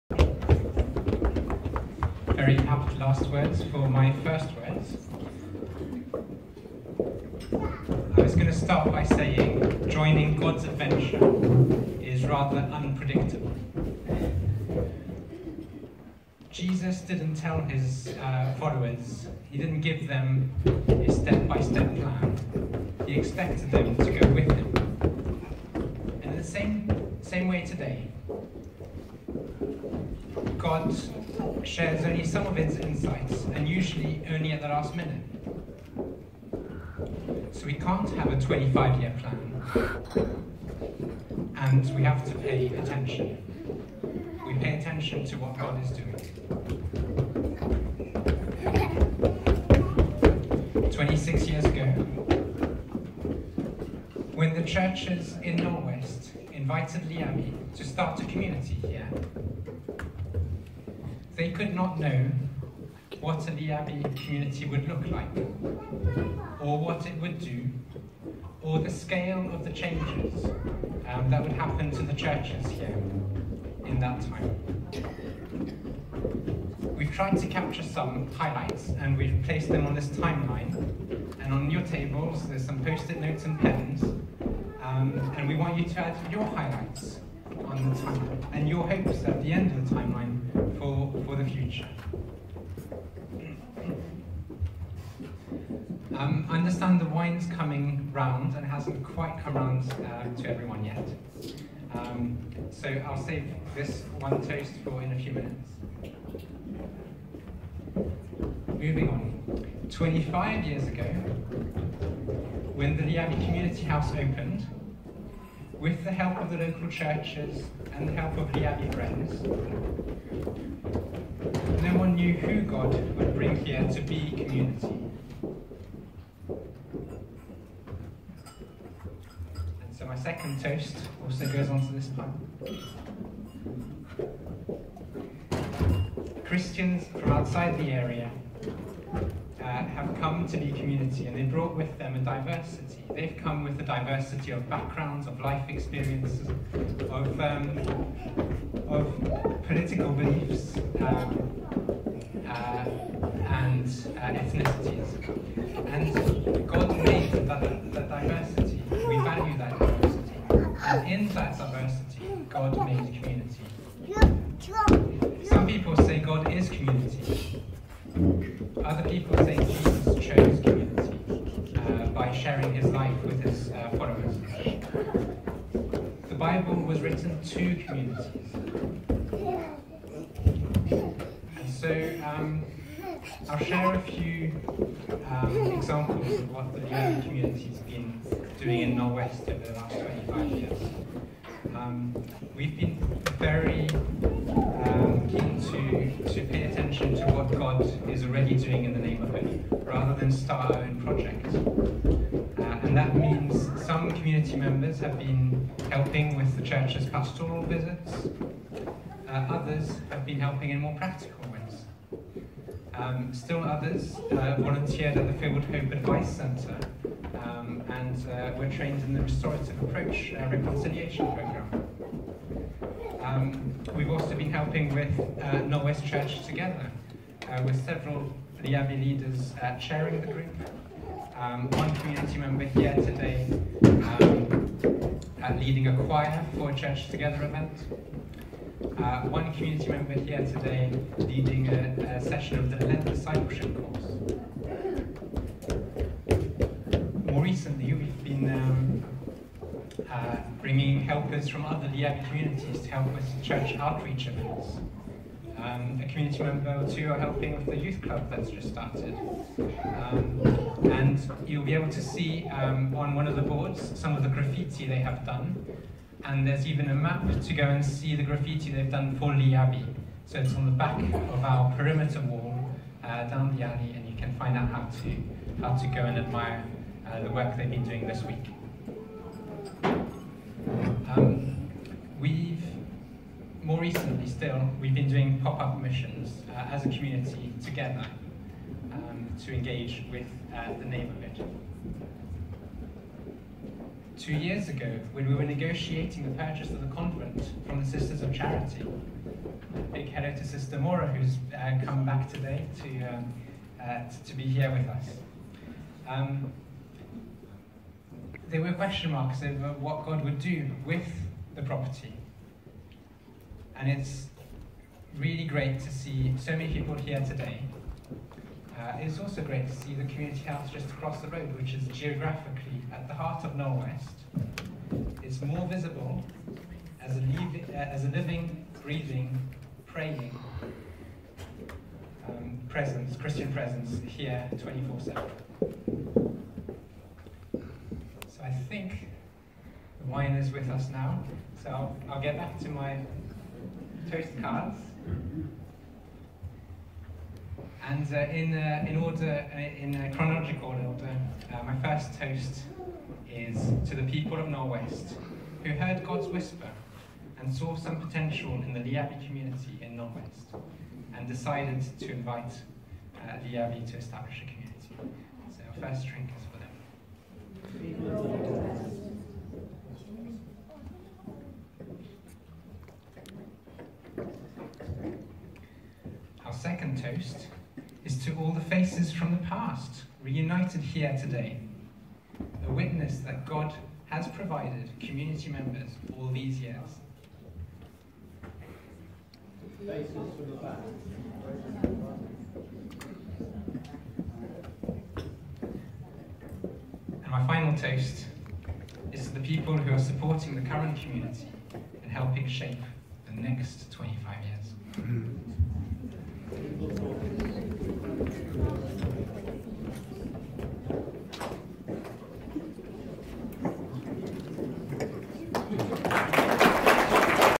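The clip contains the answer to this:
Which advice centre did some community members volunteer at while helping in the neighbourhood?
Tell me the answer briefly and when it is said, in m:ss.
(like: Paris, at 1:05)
Field Hope Advice Centre, at 3:35.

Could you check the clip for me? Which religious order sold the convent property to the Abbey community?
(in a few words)
Sisters of Charity.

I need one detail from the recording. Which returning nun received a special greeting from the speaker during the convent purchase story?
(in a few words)
Sister Mora.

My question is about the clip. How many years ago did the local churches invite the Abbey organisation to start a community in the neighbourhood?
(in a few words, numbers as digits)
26.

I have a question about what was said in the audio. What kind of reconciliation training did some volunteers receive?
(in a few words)
Restorative Approach.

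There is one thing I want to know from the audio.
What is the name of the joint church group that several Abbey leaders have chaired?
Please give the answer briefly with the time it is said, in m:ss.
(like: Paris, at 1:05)
Knowle West Church Together, at 3:45.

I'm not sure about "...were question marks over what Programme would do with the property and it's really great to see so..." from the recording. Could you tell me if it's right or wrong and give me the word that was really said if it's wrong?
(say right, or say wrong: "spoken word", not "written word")
wrong: "God", not "Programme".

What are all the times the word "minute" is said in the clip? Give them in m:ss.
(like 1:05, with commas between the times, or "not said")
0:34, 1:45.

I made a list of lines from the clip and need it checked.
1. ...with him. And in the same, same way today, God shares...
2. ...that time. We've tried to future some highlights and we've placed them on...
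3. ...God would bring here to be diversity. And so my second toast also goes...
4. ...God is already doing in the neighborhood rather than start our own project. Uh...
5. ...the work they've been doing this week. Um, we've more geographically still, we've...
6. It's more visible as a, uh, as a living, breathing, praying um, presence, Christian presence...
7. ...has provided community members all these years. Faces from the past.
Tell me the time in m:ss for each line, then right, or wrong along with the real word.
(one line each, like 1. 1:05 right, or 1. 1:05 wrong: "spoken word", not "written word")
1. 0:24 right
2. 1:13 wrong: "capture", not "future"
3. 2:02 wrong: "community", not "diversity"
4. 3:17 right
5. 4:37 wrong: "recently", not "geographically"
6. 5:25 right
7. 6:24 right.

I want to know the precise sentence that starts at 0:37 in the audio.
So we can't have a 25-year plan, and we have to pay attention.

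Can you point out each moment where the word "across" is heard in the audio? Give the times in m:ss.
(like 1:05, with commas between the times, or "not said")
5:20.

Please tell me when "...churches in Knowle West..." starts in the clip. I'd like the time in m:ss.
0:54.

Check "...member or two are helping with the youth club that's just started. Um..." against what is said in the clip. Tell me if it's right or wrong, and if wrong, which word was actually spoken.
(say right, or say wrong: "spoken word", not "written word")
right.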